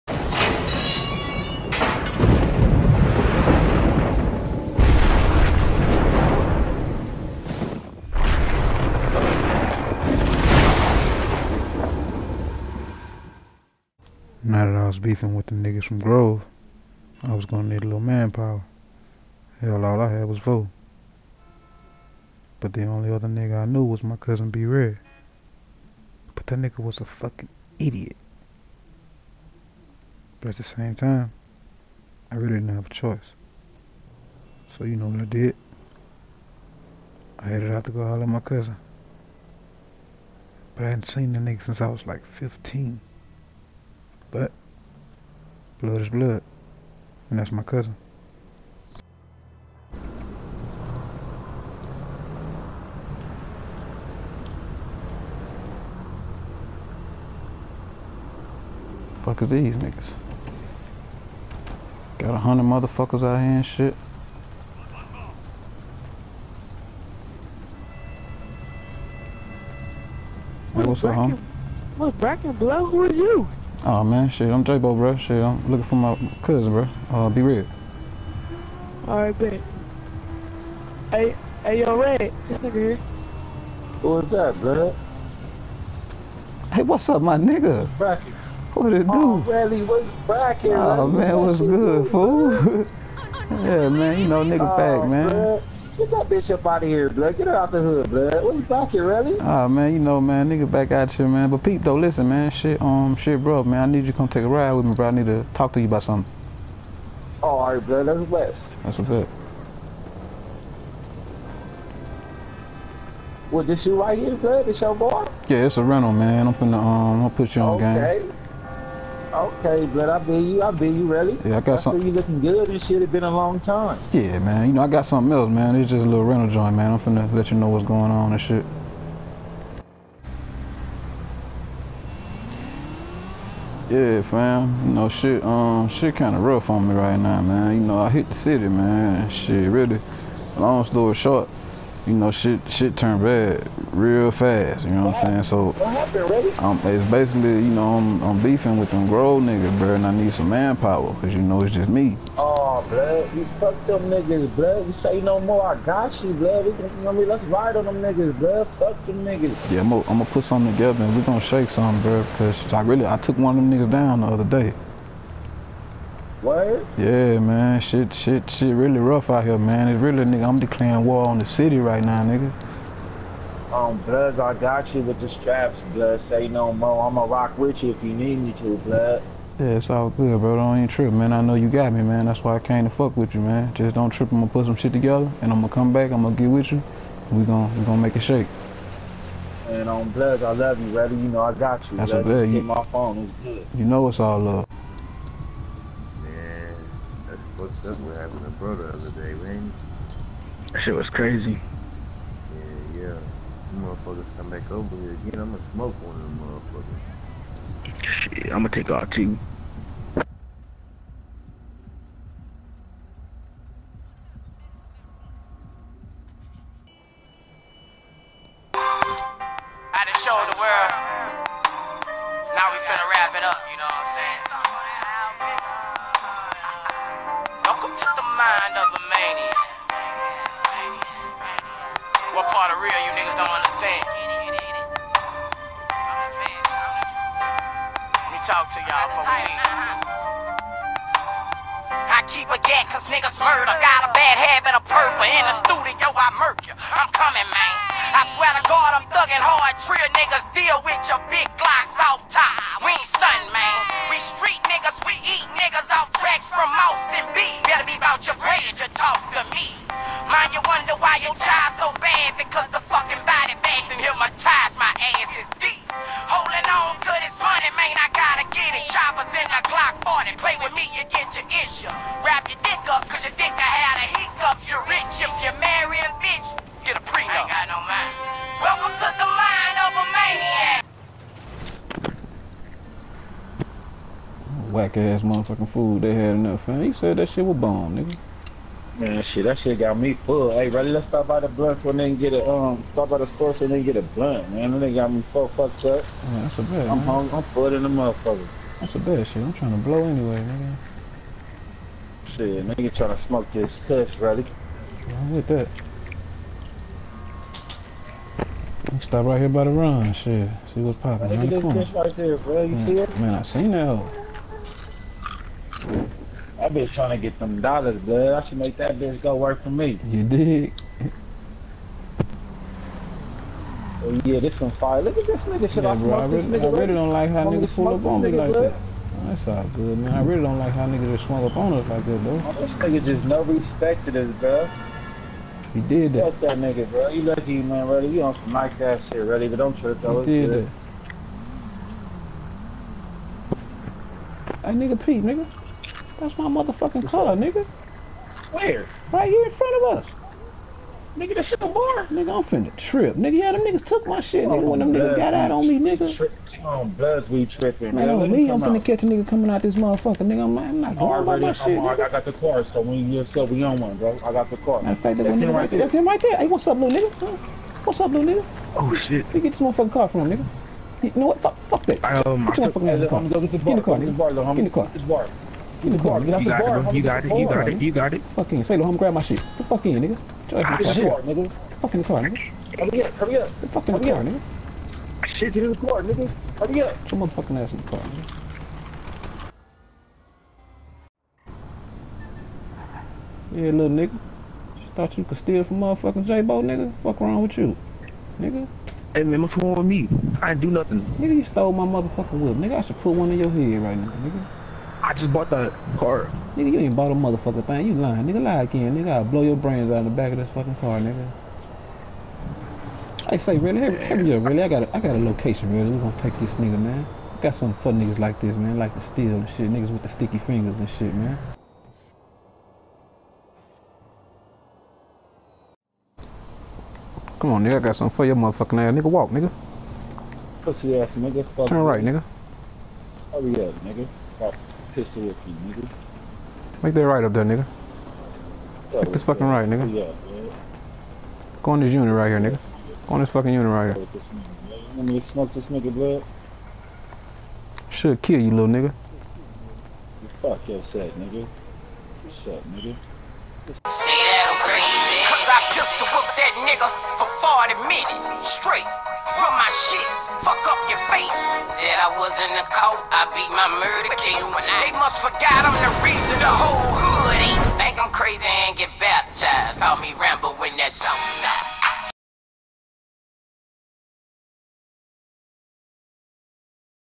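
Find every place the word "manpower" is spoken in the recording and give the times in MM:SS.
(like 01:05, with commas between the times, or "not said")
00:18, 02:30.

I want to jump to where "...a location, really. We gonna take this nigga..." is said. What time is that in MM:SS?
06:55.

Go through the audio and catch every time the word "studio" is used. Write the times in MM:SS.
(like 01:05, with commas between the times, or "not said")
04:05.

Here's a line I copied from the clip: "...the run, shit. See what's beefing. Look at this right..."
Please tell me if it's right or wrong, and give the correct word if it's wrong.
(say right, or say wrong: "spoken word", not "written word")
wrong: "popping", not "beefing".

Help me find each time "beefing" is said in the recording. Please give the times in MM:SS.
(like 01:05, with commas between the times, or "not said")
00:14, 02:28.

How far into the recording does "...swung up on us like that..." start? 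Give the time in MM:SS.
05:31.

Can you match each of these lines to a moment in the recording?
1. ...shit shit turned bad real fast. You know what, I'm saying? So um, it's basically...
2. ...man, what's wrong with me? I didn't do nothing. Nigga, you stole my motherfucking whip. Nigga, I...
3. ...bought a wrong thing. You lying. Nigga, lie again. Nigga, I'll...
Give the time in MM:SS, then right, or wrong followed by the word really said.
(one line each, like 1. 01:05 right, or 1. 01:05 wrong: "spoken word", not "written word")
1. 02:22 right
2. 06:39 right
3. 06:46 wrong: "motherfucking", not "wrong".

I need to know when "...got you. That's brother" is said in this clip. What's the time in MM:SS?
03:11.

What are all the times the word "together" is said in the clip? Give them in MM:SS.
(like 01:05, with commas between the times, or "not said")
02:40, 03:04.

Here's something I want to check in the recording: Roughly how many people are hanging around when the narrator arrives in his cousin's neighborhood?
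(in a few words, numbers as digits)
100.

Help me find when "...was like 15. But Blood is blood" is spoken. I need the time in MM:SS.
00:41.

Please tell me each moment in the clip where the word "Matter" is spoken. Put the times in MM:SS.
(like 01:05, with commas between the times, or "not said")
06:04.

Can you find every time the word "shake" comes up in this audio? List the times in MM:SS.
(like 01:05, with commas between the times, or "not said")
02:41, 03:08.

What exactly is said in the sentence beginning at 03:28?
Shit, I'm gonna take all two.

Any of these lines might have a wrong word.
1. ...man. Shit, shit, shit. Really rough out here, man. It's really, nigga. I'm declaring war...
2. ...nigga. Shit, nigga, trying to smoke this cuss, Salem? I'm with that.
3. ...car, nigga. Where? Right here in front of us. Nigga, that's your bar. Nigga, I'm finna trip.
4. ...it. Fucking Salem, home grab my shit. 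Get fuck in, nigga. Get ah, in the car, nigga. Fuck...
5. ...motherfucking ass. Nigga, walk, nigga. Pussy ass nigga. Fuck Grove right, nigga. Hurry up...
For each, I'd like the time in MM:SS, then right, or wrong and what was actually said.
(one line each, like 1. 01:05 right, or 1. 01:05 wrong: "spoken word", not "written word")
1. 02:47 right
2. 05:00 wrong: "Ready", not "Salem"
3. 05:47 right
4. 06:18 right
5. 07:08 wrong: "Turn", not "Grove".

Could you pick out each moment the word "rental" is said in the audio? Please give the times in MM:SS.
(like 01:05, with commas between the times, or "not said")
01:55, 02:06.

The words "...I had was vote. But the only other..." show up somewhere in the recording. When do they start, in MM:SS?
00:20.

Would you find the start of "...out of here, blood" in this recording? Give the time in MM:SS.
01:36.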